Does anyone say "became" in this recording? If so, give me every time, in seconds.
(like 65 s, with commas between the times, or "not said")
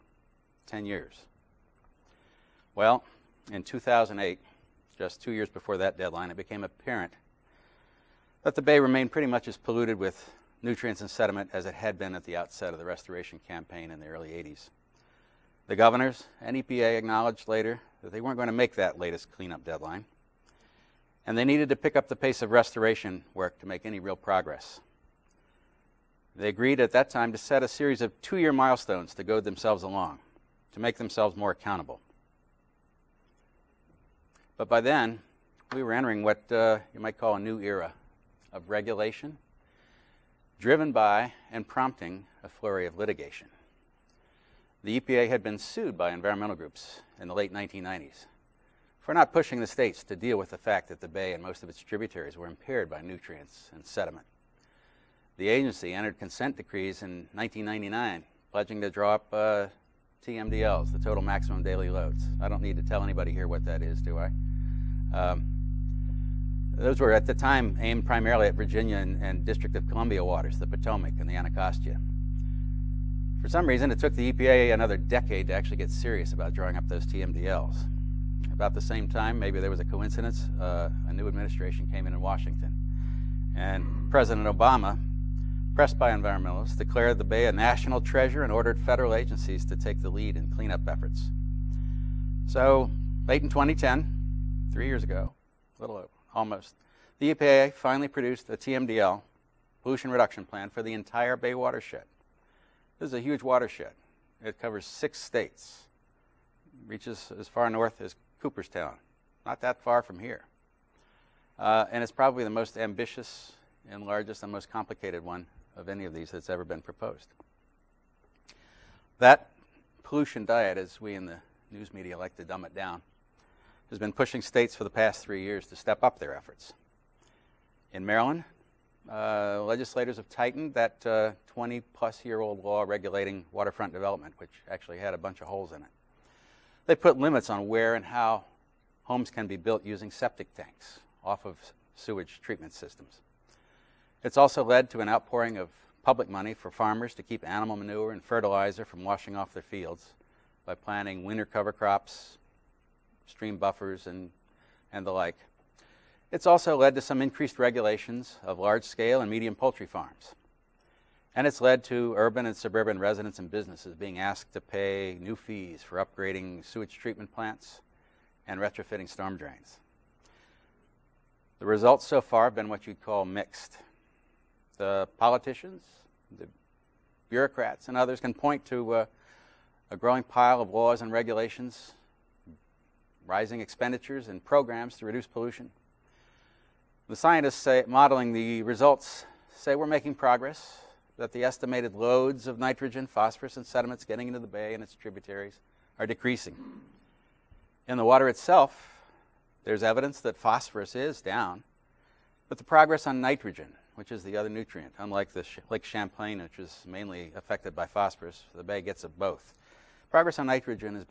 6 s.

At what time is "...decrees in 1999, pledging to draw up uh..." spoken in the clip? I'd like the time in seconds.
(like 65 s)
56 s.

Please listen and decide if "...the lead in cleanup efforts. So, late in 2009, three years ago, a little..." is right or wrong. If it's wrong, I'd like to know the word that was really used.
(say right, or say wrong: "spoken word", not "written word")
wrong: "2010", not "2009".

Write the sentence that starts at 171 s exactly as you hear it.
The results so far have been what you'd call mixed.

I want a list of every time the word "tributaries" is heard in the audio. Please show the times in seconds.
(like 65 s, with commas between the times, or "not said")
51 s, 194 s.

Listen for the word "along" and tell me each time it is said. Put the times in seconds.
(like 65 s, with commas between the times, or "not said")
29 s.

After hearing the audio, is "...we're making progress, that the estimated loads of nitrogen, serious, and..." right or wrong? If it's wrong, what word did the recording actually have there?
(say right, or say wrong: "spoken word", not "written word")
wrong: "phosphorus", not "serious".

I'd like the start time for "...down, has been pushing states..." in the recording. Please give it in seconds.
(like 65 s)
122 s.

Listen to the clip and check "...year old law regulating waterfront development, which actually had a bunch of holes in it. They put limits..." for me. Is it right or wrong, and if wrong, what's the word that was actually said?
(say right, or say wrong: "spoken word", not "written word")
right.